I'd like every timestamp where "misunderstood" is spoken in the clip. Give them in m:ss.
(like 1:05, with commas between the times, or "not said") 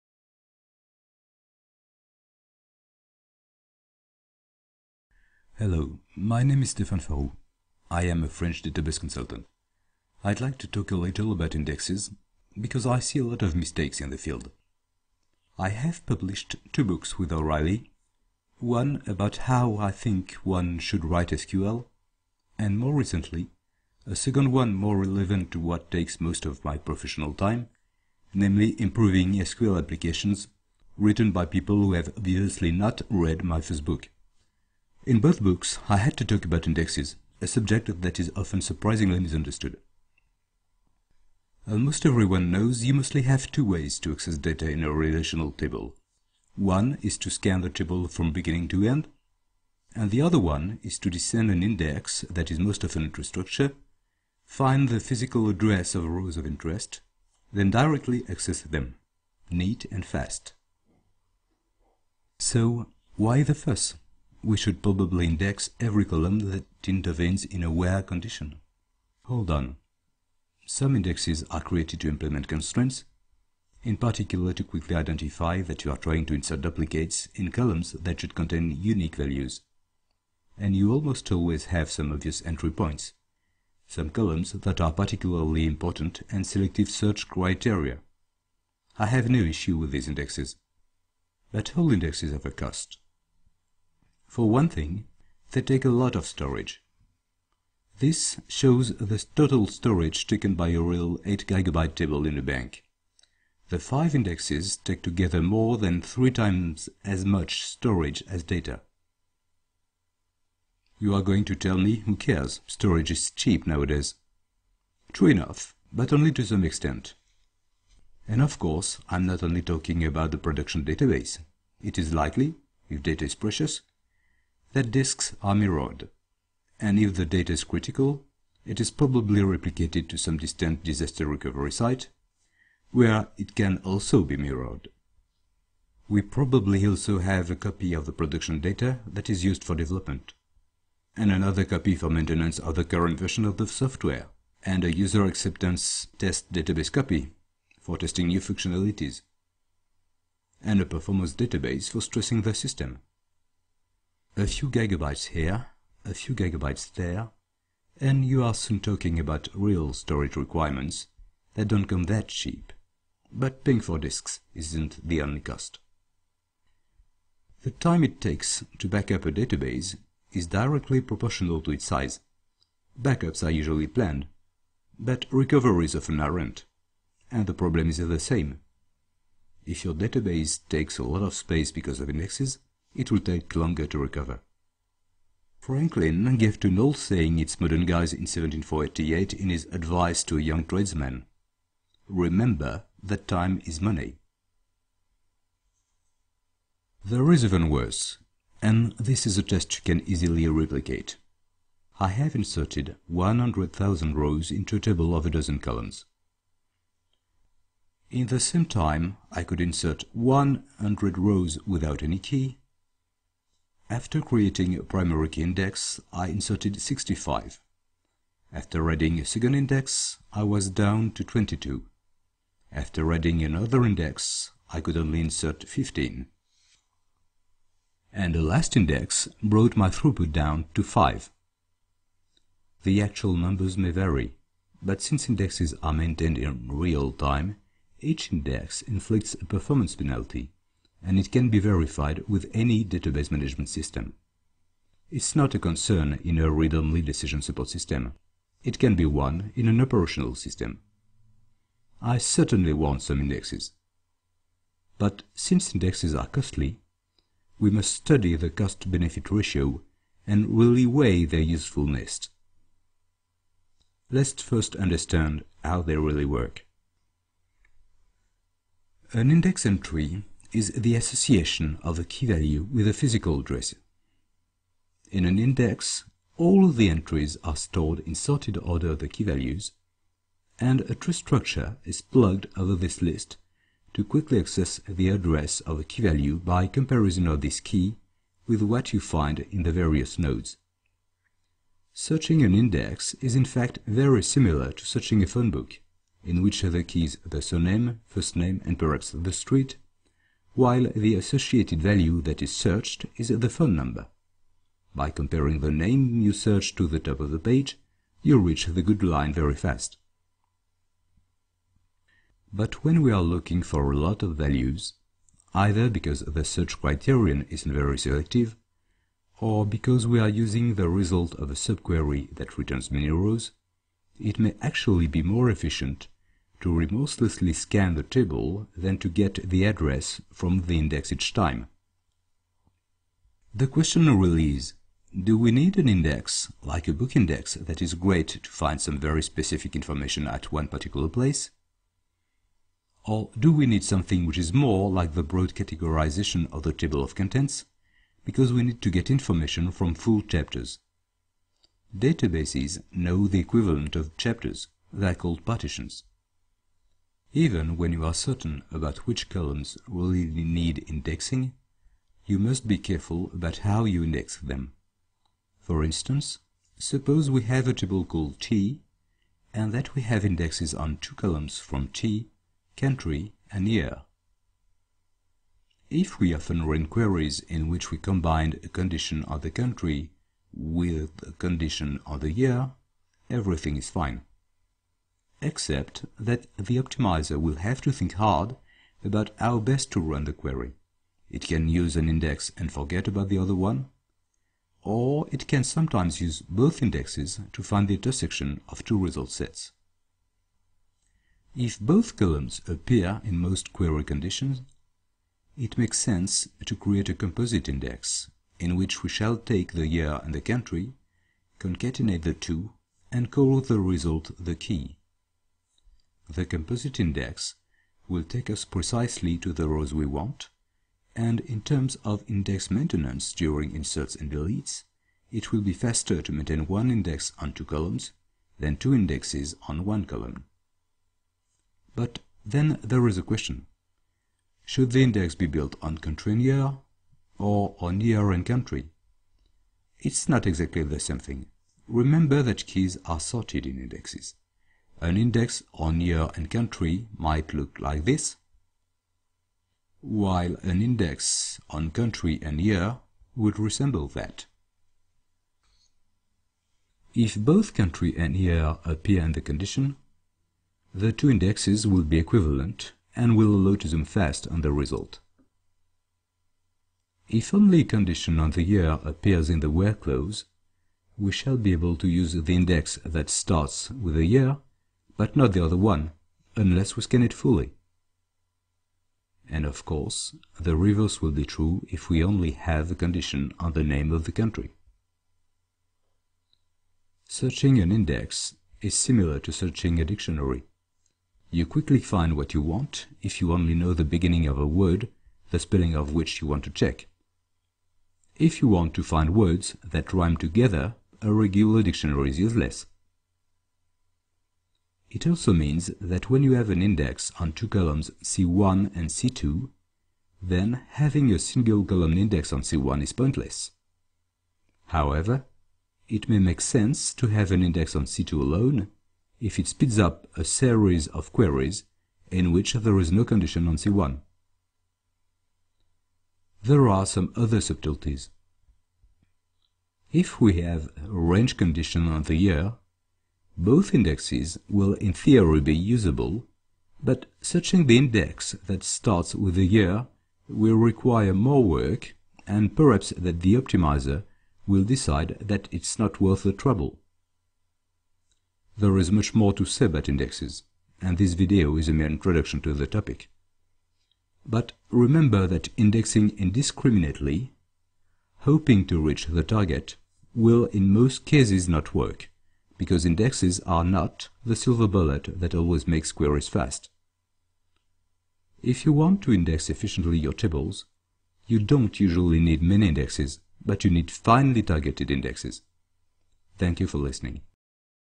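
0:39.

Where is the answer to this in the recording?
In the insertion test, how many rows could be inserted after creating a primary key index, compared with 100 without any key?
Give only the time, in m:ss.
3:36.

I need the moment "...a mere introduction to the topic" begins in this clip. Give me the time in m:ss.
9:11.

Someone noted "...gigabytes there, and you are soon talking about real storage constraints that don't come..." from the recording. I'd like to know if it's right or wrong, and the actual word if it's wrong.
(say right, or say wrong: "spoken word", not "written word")
wrong: "requirements", not "constraints".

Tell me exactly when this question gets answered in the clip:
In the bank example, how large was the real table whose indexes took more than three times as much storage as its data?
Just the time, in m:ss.
1:41.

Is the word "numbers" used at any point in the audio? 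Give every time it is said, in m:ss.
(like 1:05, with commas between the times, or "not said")
3:53, 5:03.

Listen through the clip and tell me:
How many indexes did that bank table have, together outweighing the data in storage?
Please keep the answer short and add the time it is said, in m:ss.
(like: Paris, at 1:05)
5, at 1:43.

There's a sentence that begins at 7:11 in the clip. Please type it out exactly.
But then there is a question.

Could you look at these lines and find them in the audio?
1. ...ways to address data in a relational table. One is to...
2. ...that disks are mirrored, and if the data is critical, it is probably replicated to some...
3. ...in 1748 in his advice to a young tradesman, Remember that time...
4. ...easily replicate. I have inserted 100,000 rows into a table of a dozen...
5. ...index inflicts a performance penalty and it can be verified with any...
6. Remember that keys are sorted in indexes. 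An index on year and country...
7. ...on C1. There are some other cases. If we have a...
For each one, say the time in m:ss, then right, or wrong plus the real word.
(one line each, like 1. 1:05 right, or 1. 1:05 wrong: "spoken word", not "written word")
1. 0:43 wrong: "access", not "address"
2. 2:04 right
3. 3:08 right
4. 3:20 right
5. 3:58 right
6. 7:21 right
7. 8:43 wrong: "subtleties", not "cases".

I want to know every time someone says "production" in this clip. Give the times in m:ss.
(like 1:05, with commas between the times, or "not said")
2:00, 2:18.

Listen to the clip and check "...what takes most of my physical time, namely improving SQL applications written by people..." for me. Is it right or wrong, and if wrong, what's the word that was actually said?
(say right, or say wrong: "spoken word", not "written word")
wrong: "professional", not "physical".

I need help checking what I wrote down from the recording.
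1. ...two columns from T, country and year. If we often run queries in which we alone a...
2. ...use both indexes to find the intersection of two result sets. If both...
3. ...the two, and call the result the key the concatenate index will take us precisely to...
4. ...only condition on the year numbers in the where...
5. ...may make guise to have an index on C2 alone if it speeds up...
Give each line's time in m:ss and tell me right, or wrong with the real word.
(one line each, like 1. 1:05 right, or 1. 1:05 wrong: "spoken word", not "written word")
1. 6:10 wrong: "combine", not "alone"
2. 6:36 right
3. 6:52 wrong: "composite", not "concatenate"
4. 7:47 wrong: "appears", not "numbers"
5. 8:36 wrong: "sense", not "guise".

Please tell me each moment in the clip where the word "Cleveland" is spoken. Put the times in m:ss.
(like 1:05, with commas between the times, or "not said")
not said.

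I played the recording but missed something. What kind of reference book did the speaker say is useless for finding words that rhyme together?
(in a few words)
A regular dictionary.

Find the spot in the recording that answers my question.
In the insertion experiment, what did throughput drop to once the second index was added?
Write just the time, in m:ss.
3:41.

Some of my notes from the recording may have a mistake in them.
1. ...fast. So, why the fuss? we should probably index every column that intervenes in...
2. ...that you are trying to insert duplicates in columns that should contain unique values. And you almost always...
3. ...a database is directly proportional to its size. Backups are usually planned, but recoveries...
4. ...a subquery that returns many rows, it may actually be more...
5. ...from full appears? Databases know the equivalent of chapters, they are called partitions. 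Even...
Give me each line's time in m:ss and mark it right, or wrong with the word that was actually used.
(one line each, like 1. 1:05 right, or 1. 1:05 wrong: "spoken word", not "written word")
1. 1:00 right
2. 1:15 right
3. 2:49 right
4. 5:21 right
5. 5:49 wrong: "chapters", not "appears".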